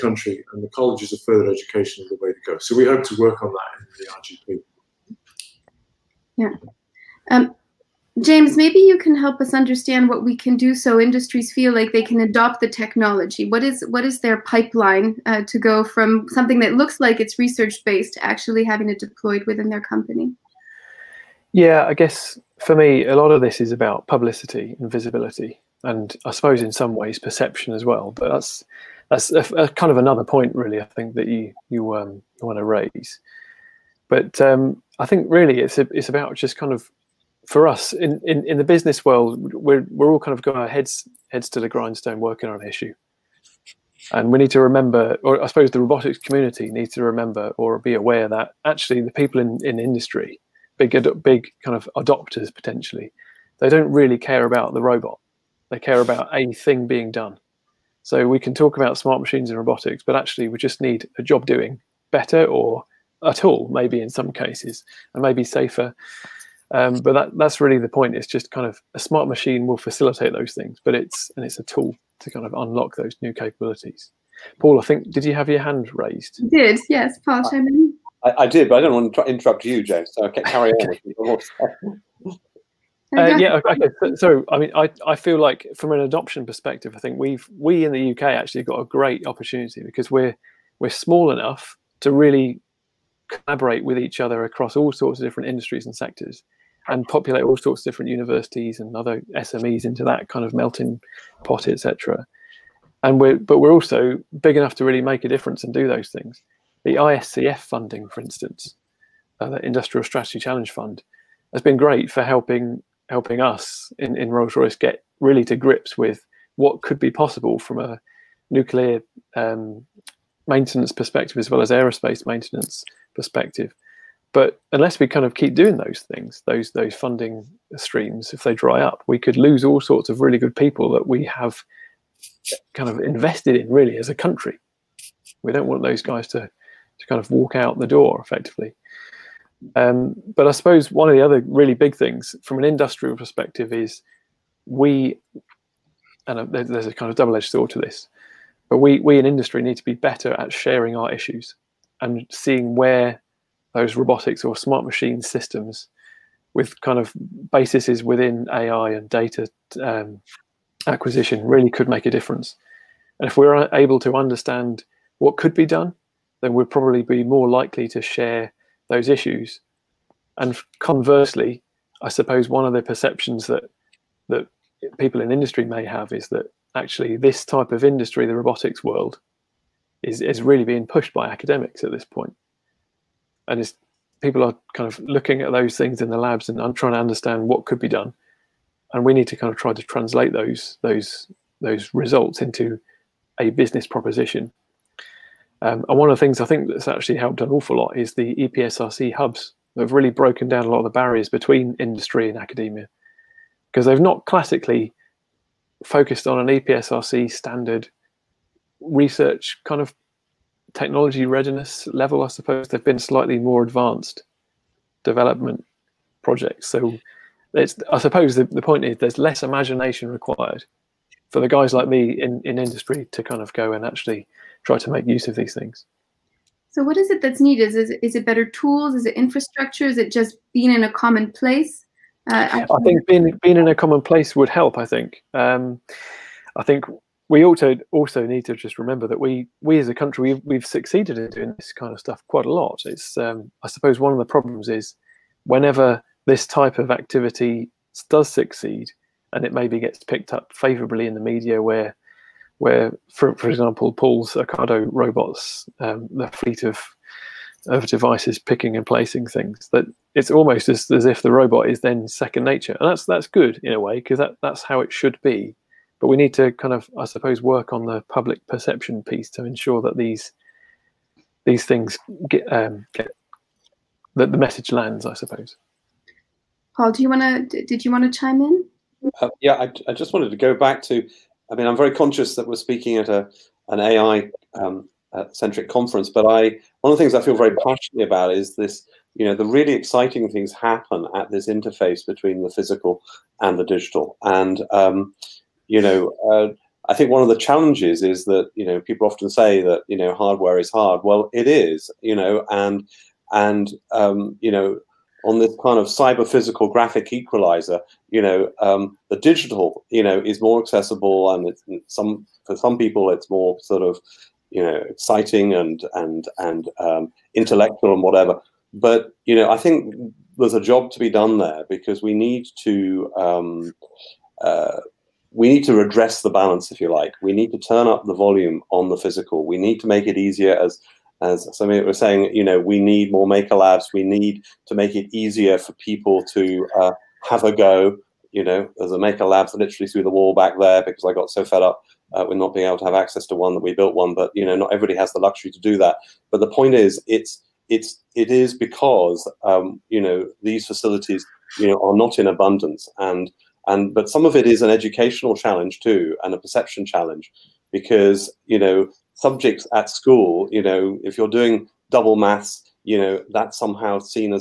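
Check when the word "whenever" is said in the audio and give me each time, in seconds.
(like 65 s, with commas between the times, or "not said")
245 s.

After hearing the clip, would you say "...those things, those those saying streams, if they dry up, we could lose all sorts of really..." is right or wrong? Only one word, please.
wrong.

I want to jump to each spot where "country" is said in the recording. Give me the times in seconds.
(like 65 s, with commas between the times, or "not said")
134 s, 239 s.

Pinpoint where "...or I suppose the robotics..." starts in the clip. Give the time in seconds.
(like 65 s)
45 s.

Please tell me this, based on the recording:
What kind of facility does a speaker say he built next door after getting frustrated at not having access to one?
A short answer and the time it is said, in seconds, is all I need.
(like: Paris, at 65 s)
maker lab, at 338 s.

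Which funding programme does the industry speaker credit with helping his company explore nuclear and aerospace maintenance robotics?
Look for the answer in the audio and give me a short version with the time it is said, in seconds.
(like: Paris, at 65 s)
Industrial Strategy Challenge Fund, at 109 s.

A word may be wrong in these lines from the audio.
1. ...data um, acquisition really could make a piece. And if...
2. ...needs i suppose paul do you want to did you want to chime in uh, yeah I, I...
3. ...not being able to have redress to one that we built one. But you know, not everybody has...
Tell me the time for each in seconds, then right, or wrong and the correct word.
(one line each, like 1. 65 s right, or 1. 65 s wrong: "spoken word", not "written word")
1. 159 s wrong: "difference", not "piece"
2. 274 s wrong: "lands", not "needs"
3. 342 s wrong: "access", not "redress".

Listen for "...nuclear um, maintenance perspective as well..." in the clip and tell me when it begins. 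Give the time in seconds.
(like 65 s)
118 s.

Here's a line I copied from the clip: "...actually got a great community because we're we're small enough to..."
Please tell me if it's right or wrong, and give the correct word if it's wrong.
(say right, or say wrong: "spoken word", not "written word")
wrong: "opportunity", not "community".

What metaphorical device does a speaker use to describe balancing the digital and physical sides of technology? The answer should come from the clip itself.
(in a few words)
graphic equalizer.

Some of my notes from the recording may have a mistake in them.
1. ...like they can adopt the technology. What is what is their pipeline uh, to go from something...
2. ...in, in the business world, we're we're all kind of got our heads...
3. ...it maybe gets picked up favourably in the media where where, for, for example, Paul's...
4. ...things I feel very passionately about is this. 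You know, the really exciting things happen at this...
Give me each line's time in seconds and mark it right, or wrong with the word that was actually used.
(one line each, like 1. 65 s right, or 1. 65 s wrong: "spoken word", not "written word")
1. 11 s right
2. 38 s right
3. 249 s right
4. 287 s right.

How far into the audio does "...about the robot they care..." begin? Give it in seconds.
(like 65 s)
54 s.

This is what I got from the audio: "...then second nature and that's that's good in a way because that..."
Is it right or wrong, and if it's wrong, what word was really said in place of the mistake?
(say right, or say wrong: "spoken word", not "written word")
right.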